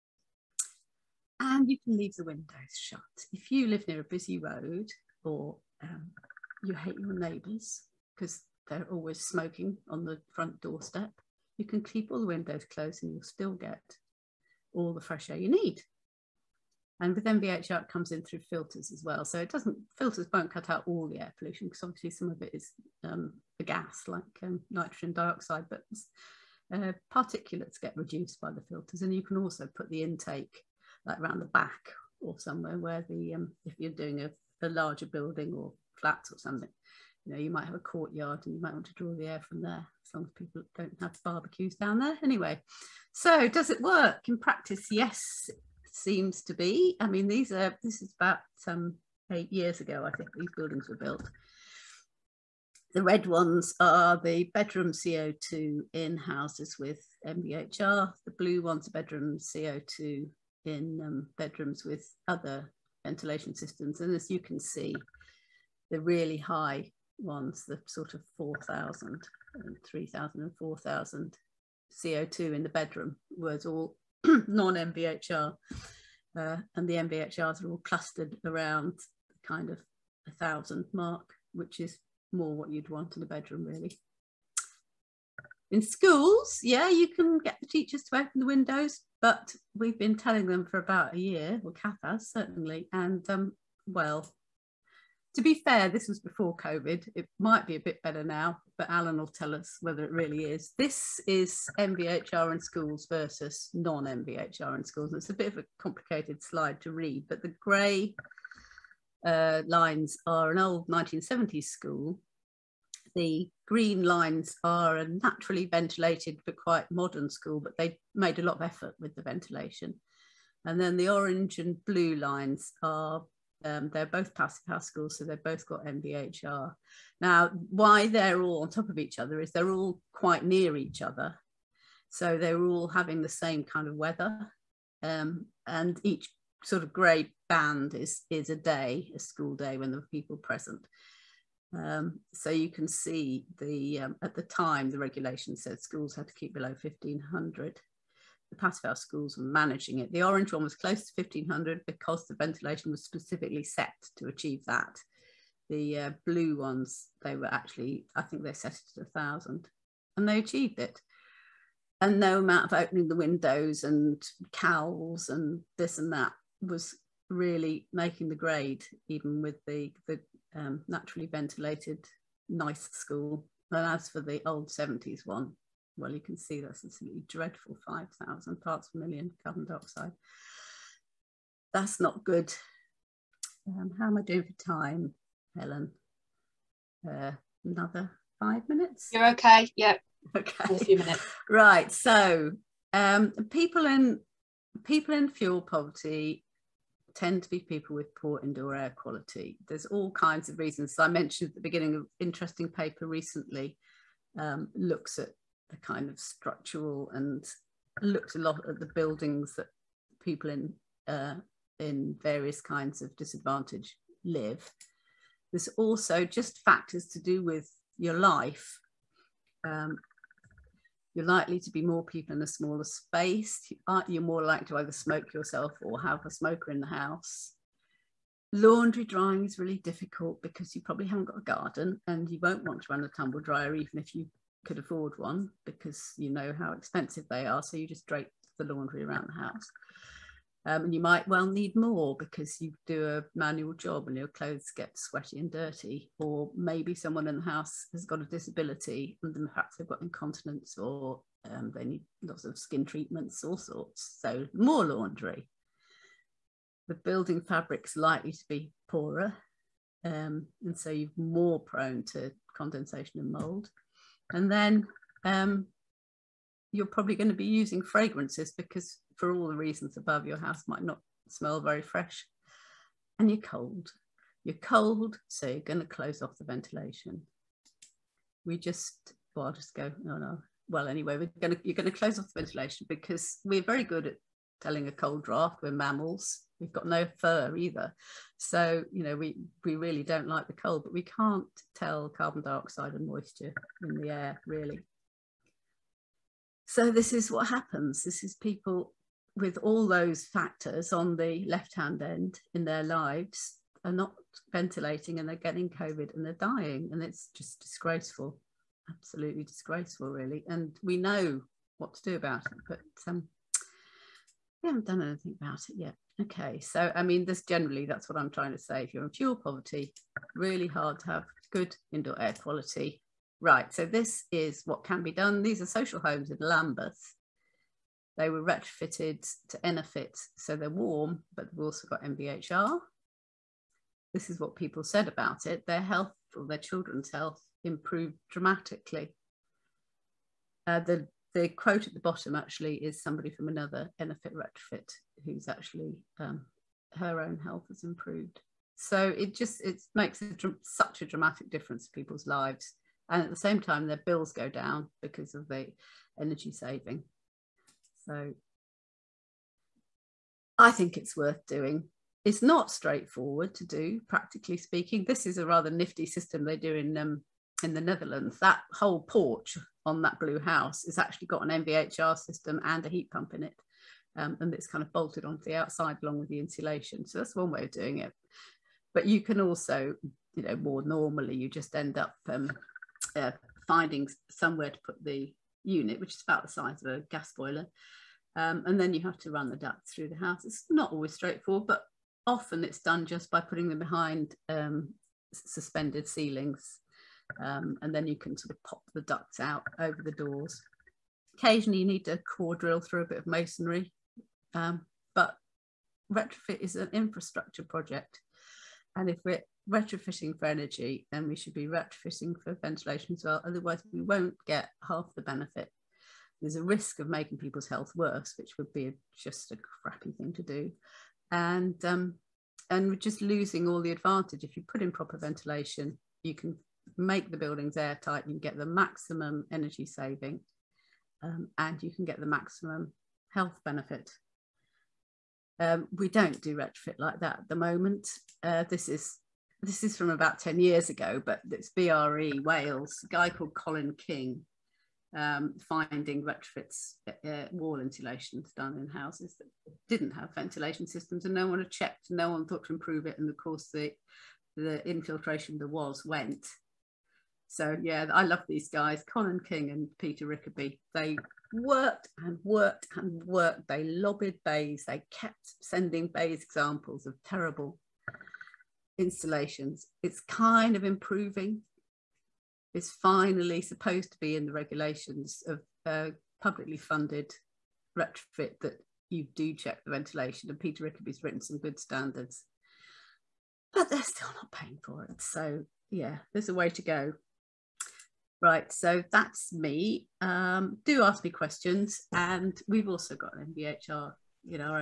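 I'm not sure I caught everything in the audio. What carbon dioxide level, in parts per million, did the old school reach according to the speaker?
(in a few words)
5,000.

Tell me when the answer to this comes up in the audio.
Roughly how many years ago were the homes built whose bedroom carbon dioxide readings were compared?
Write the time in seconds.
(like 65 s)
49 s.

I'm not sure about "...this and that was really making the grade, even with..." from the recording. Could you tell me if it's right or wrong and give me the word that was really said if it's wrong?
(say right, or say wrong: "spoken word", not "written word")
right.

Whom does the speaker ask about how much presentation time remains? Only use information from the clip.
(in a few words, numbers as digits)
Helen.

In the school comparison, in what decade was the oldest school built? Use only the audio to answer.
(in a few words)
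1970s.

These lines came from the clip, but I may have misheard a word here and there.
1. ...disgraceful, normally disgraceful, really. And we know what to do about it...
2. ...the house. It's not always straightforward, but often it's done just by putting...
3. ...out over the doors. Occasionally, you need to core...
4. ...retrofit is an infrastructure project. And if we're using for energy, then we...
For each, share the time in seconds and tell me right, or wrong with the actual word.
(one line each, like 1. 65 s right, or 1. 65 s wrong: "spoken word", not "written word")
1. 307 s wrong: "absolutely", not "normally"
2. 390 s right
3. 399 s right
4. 406 s wrong: "retrofitting", not "using".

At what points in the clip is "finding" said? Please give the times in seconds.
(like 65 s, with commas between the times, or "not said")
383 s, 445 s.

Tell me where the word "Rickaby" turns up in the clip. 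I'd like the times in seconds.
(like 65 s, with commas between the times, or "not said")
460 s, 480 s.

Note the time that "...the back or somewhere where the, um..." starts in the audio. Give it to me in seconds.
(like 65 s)
31 s.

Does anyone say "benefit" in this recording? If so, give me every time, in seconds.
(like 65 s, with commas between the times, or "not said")
415 s, 433 s.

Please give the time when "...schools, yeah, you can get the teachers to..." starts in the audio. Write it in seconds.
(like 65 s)
85 s.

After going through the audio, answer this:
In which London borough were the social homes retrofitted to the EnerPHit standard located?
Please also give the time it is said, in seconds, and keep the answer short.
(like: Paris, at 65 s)
Lambeth, at 326 s.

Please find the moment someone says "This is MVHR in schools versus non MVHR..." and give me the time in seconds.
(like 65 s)
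100 s.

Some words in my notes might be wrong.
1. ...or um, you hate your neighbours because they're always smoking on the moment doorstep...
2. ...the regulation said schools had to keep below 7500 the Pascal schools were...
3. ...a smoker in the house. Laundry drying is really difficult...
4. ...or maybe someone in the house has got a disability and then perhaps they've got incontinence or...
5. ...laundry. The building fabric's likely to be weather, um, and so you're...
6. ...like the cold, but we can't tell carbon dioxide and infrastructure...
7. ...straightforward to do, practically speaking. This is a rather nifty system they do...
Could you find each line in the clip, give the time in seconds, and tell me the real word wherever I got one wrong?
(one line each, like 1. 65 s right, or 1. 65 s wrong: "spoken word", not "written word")
1. 5 s wrong: "front", not "moment"
2. 144 s wrong: "1500", not "7500"
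3. 226 s right
4. 246 s right
5. 254 s wrong: "poorer", not "weather"
6. 290 s wrong: "moisture", not "infrastructure"
7. 362 s right.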